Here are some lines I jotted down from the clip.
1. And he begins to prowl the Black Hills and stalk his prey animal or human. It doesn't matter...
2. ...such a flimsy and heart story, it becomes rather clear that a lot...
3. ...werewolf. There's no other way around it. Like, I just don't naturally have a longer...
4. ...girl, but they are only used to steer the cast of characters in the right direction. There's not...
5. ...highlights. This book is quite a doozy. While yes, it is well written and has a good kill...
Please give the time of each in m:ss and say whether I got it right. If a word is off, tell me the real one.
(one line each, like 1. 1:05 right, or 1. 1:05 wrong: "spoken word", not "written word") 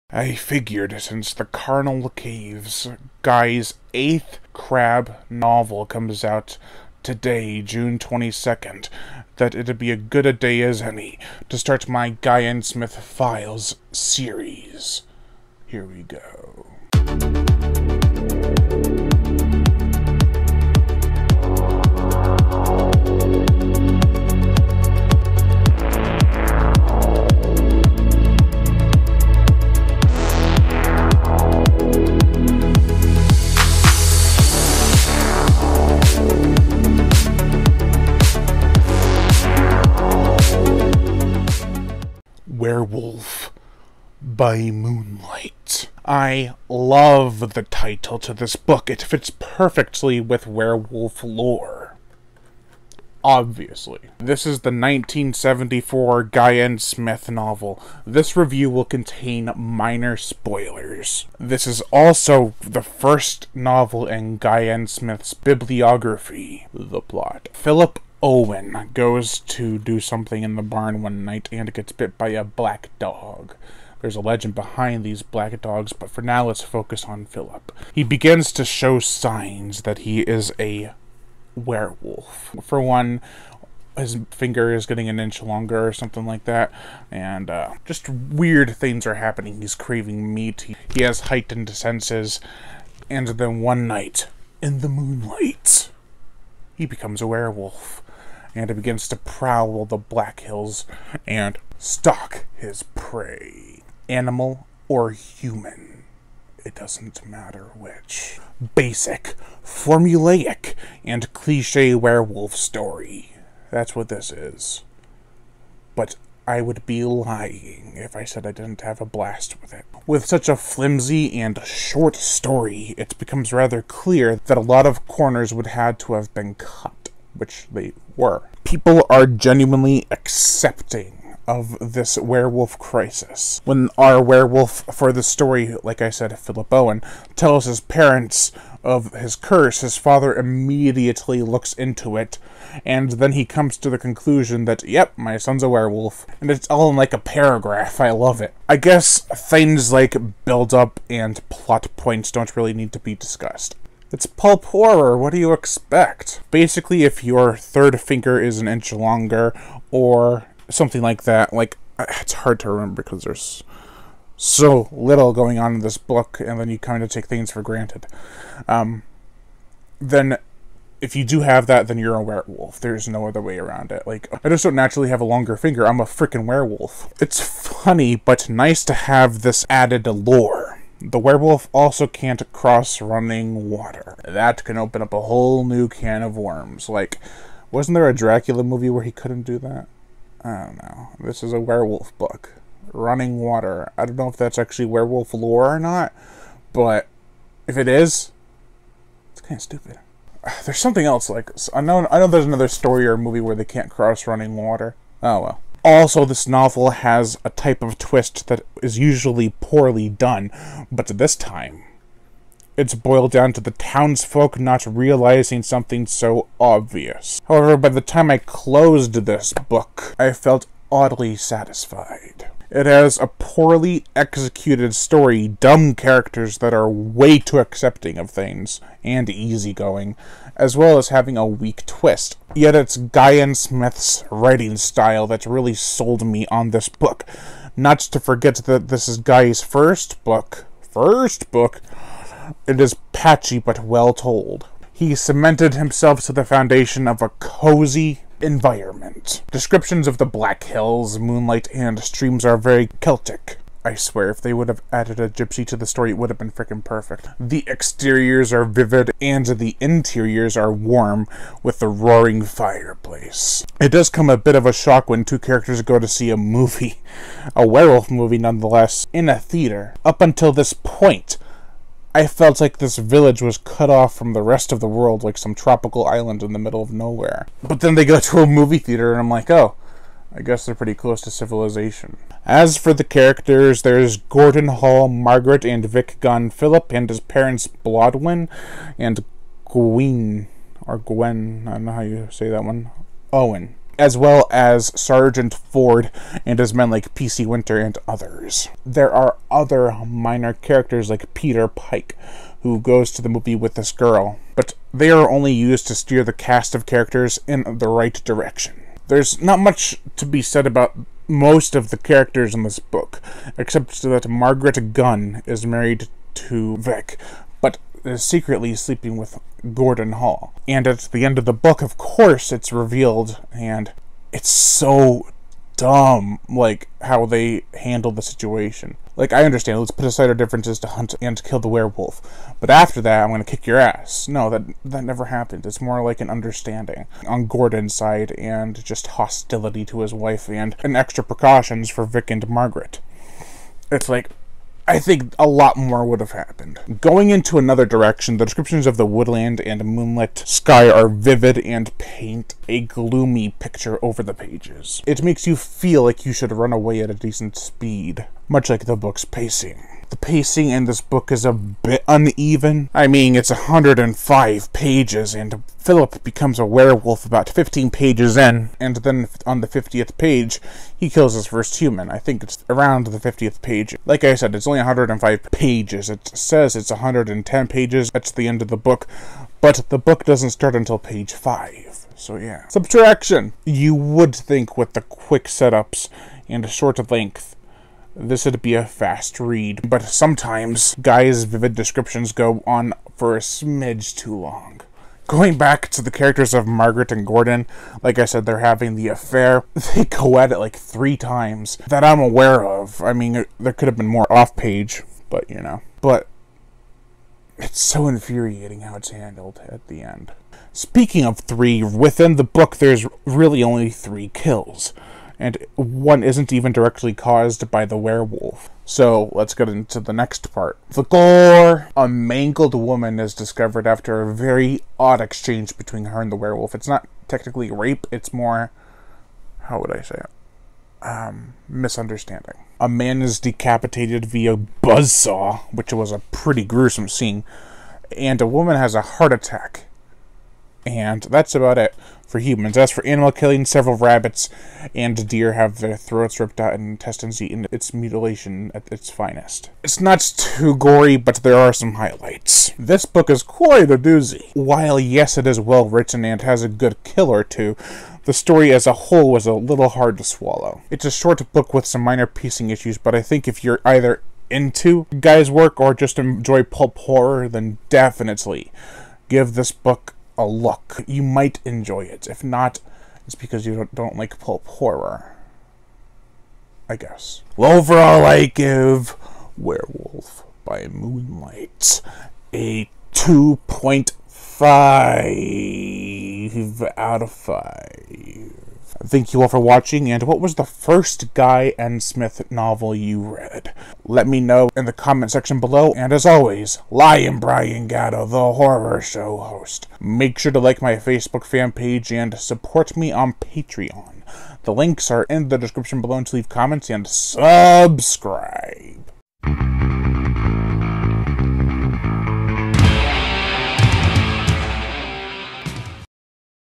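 1. 1:38 right
2. 2:00 wrong: "short", not "heart"
3. 2:52 right
4. 5:03 right
5. 7:31 right.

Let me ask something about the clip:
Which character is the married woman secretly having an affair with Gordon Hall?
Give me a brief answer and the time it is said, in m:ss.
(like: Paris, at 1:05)
Margaret Gunn, at 5:14.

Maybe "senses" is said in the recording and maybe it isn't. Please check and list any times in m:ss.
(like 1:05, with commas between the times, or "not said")
1:31.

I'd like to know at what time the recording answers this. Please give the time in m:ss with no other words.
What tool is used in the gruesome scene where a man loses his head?
7:14.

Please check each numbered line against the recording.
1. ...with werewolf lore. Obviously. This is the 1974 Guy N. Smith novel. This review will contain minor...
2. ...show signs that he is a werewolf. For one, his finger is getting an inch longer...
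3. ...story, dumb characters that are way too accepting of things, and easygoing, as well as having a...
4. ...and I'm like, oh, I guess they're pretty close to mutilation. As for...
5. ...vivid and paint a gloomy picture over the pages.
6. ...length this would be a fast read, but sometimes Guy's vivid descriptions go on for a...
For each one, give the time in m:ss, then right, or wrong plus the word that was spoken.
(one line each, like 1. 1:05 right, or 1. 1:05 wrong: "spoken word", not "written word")
1. 0:50 right
2. 1:18 right
3. 3:44 right
4. 4:39 wrong: "civilization", not "mutilation"
5. 5:51 right
6. 6:27 right.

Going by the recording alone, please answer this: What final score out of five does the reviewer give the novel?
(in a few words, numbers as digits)
2.5.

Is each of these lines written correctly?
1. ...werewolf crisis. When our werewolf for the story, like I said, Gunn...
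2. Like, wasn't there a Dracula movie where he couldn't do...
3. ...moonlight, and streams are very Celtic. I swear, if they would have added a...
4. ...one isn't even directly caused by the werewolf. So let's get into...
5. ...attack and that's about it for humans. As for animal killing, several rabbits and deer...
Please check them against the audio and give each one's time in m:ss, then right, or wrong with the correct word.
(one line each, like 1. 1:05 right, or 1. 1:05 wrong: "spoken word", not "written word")
1. 2:12 wrong: "Philip", not "Gunn"
2. 3:06 right
3. 4:11 right
4. 6:55 right
5. 7:19 right.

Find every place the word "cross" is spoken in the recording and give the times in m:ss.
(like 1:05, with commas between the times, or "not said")
3:02, 3:23.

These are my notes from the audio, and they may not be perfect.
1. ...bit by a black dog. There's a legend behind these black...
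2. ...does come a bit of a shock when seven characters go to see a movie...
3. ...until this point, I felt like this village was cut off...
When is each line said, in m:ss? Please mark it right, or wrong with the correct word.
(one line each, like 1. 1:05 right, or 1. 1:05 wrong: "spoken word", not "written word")
1. 1:11 right
2. 4:23 wrong: "two", not "seven"
3. 4:30 right.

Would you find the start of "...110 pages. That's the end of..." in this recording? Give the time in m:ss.
6:16.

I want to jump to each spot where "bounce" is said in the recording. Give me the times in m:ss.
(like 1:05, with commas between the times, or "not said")
not said.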